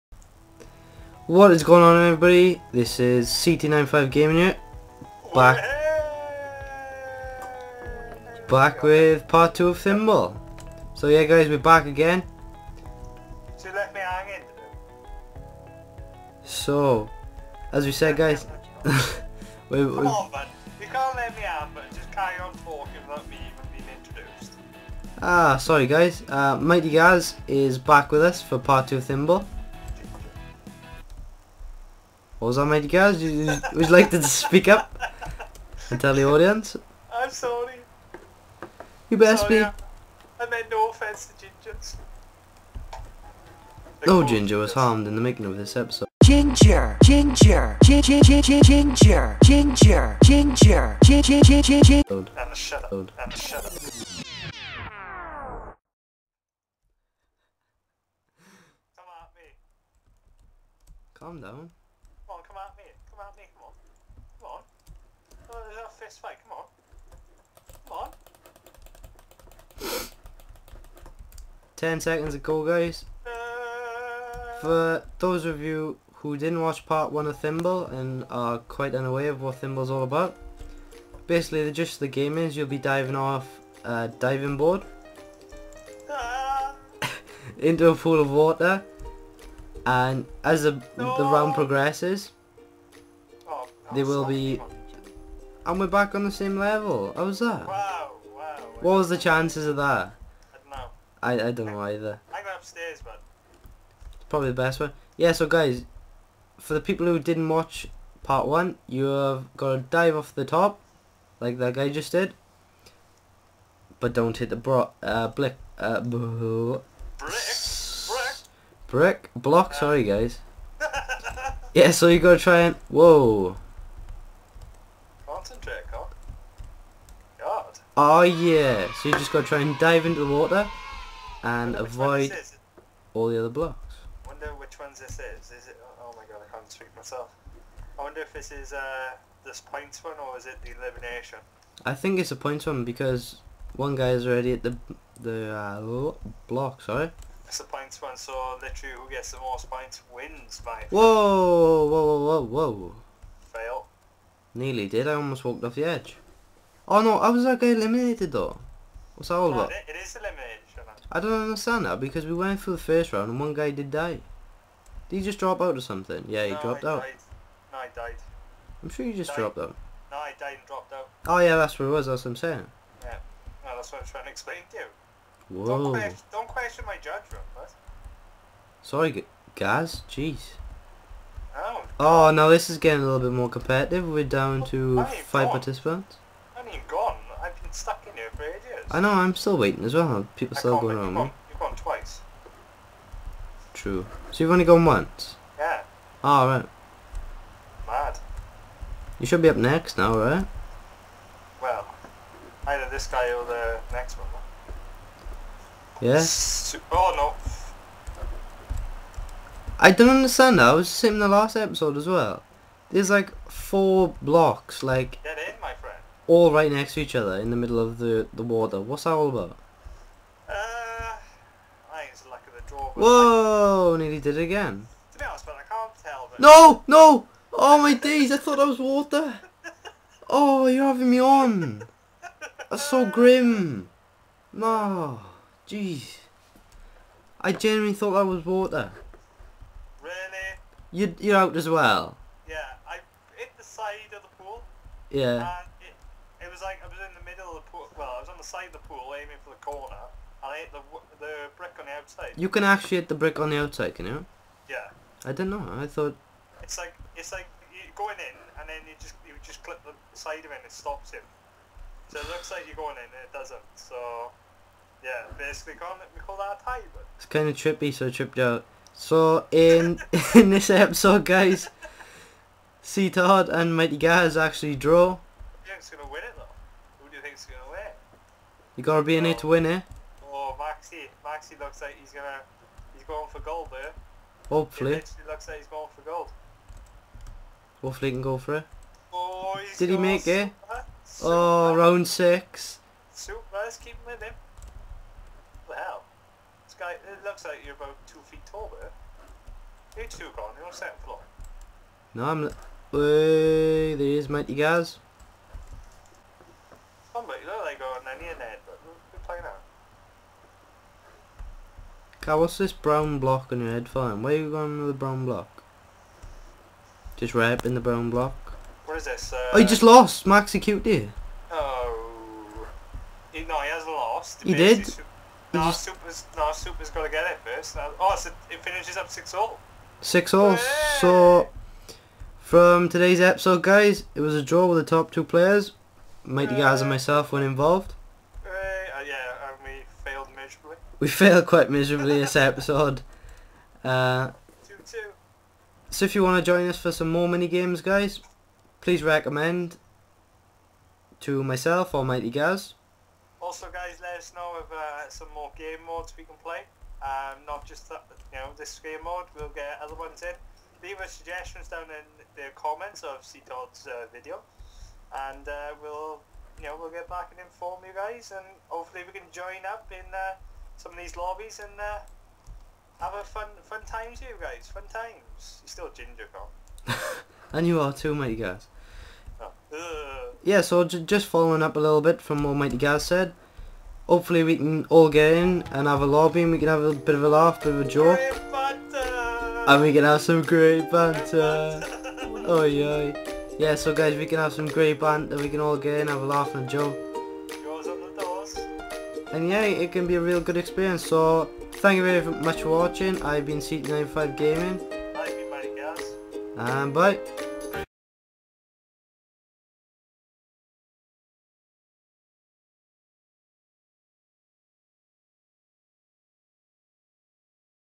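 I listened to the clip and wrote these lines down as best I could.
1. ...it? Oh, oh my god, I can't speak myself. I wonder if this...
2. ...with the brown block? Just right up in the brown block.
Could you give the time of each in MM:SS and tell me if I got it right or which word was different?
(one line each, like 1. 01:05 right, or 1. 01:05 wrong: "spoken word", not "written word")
1. 02:15 right
2. 05:14 right.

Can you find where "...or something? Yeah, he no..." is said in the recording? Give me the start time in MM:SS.
02:45.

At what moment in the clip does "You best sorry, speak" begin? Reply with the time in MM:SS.
00:39.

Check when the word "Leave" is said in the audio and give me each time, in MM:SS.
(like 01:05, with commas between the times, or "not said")
06:00.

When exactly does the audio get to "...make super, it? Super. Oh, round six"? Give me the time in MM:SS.
04:49.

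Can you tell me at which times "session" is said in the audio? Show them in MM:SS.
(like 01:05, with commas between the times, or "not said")
not said.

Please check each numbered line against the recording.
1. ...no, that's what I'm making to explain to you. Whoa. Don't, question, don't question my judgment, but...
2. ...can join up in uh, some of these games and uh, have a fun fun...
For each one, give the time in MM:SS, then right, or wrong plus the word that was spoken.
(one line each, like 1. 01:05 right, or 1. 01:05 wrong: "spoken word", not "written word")
1. 02:53 wrong: "trying", not "making"
2. 06:09 wrong: "lobbies", not "games".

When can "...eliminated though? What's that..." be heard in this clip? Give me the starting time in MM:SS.
02:37.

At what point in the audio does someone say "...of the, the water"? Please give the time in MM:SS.
03:37.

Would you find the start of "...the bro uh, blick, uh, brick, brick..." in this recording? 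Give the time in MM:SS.
01:54.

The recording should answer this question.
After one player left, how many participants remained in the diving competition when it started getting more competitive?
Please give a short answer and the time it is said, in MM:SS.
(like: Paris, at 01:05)
5, at 03:05.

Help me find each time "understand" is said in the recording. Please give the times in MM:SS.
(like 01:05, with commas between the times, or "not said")
02:41, 03:30.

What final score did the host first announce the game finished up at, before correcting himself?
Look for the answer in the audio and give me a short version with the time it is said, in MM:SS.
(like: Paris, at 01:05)
6 all, at 05:29.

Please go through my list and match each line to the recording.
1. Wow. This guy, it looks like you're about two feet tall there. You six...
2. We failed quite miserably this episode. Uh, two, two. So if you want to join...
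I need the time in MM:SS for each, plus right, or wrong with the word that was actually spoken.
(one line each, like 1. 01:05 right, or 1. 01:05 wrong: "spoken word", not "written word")
1. 04:55 wrong: "two", not "six"
2. 05:40 right.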